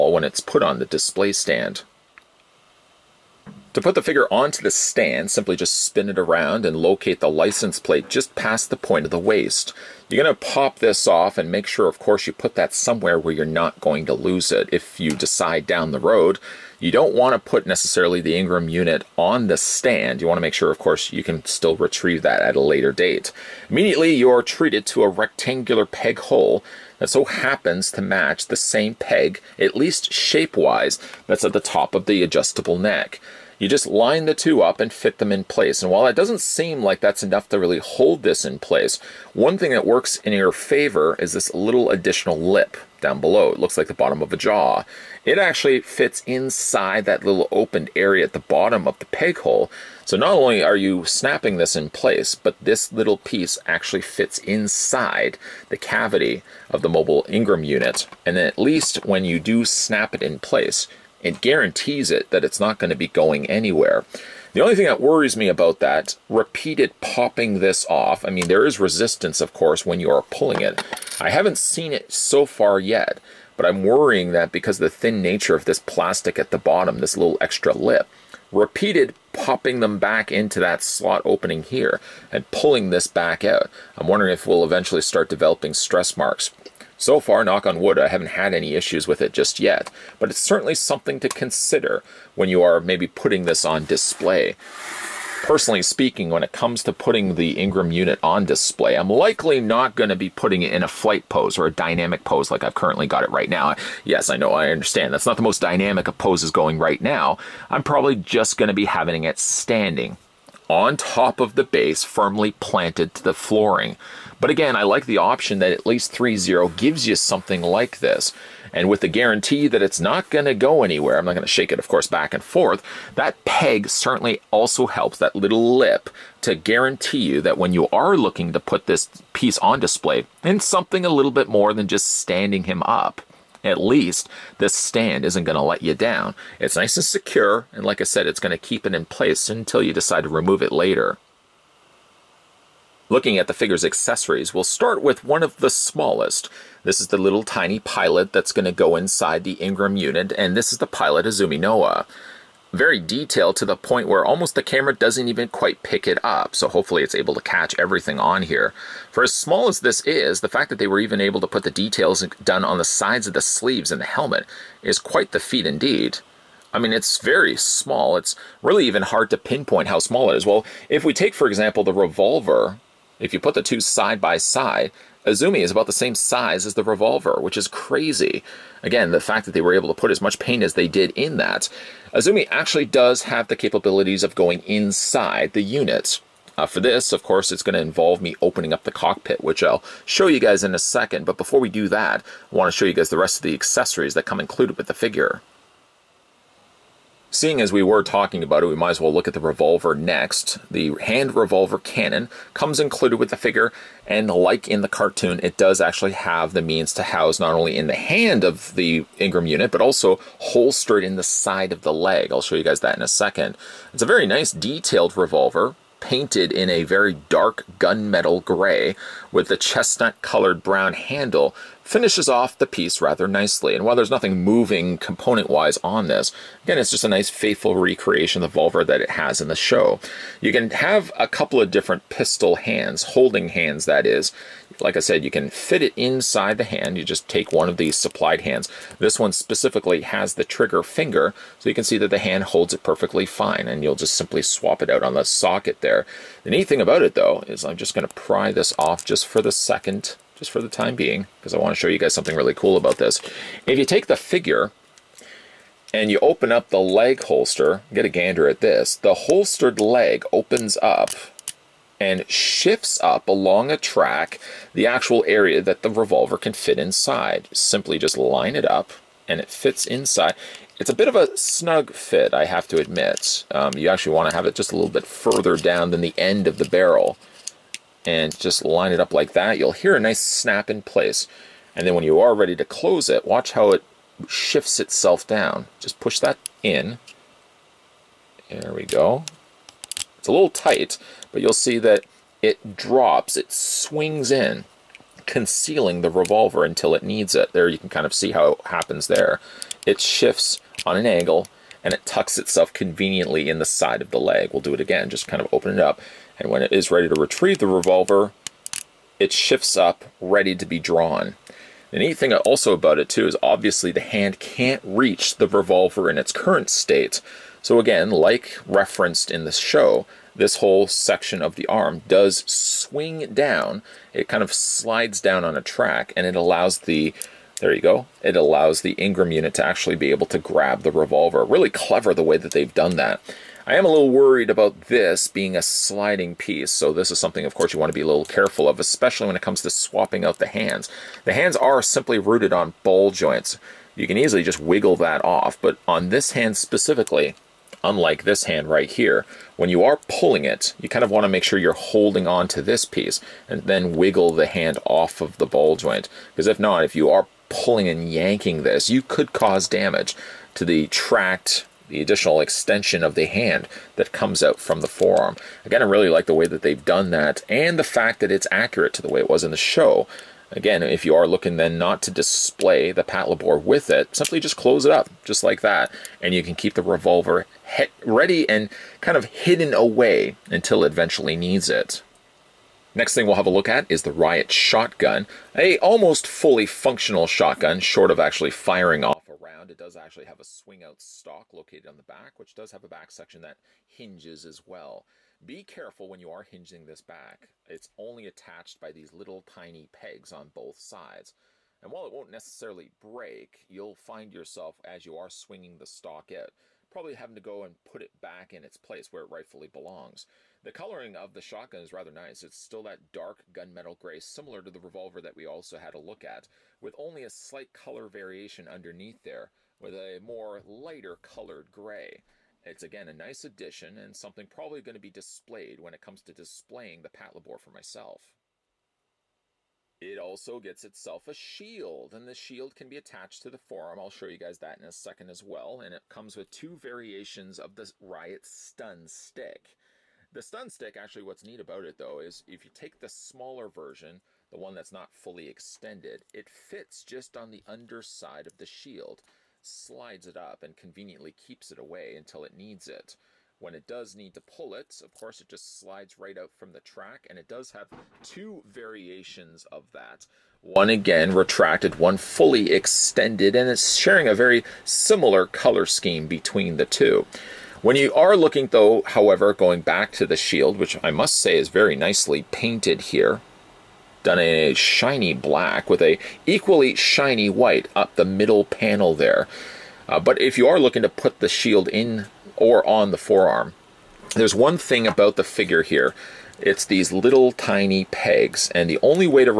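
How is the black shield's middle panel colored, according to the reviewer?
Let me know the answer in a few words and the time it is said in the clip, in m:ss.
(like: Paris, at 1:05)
shiny white, at 7:56.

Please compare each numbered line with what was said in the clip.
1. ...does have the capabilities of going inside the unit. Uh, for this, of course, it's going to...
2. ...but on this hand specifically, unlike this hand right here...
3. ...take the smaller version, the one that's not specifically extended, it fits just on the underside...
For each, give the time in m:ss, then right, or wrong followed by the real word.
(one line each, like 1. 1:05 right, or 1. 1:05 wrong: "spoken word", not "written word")
1. 3:02 right
2. 5:45 right
3. 7:22 wrong: "fully", not "specifically".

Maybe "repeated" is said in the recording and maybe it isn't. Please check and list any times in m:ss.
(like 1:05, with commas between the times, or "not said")
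1:06, 1:18.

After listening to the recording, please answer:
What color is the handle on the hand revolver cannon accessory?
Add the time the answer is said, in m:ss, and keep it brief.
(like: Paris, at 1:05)
chestnut colored brown, at 3:39.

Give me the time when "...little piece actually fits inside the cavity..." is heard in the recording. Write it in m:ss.
0:52.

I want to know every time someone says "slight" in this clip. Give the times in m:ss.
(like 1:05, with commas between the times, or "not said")
6:57.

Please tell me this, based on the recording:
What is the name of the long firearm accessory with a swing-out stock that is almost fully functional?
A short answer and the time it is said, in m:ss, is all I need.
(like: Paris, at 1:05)
Riot Shotgun, at 6:24.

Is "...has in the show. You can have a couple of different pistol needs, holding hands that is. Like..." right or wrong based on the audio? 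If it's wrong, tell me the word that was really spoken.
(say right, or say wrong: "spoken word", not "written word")
wrong: "hands", not "needs".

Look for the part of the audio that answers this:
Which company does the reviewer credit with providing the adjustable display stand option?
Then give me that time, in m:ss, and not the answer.
1:56.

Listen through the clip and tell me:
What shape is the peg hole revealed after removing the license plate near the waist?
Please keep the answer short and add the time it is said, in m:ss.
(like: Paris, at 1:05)
rectangular, at 0:25.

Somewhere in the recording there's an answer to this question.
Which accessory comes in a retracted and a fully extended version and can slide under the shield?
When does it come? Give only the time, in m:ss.
7:17.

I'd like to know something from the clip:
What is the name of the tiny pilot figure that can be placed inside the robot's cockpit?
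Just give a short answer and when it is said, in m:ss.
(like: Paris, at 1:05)
Azumi Noa, at 2:31.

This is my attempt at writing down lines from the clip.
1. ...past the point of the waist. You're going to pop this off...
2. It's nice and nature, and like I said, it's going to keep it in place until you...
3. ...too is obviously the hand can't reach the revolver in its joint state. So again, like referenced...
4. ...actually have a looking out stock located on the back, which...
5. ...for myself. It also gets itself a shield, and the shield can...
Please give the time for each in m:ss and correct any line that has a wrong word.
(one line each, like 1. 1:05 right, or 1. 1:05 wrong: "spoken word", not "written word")
1. 0:08 right
2. 2:16 wrong: "secure", not "nature"
3. 5:13 wrong: "current", not "joint"
4. 6:29 wrong: "swing", not "looking"
5. 7:07 right.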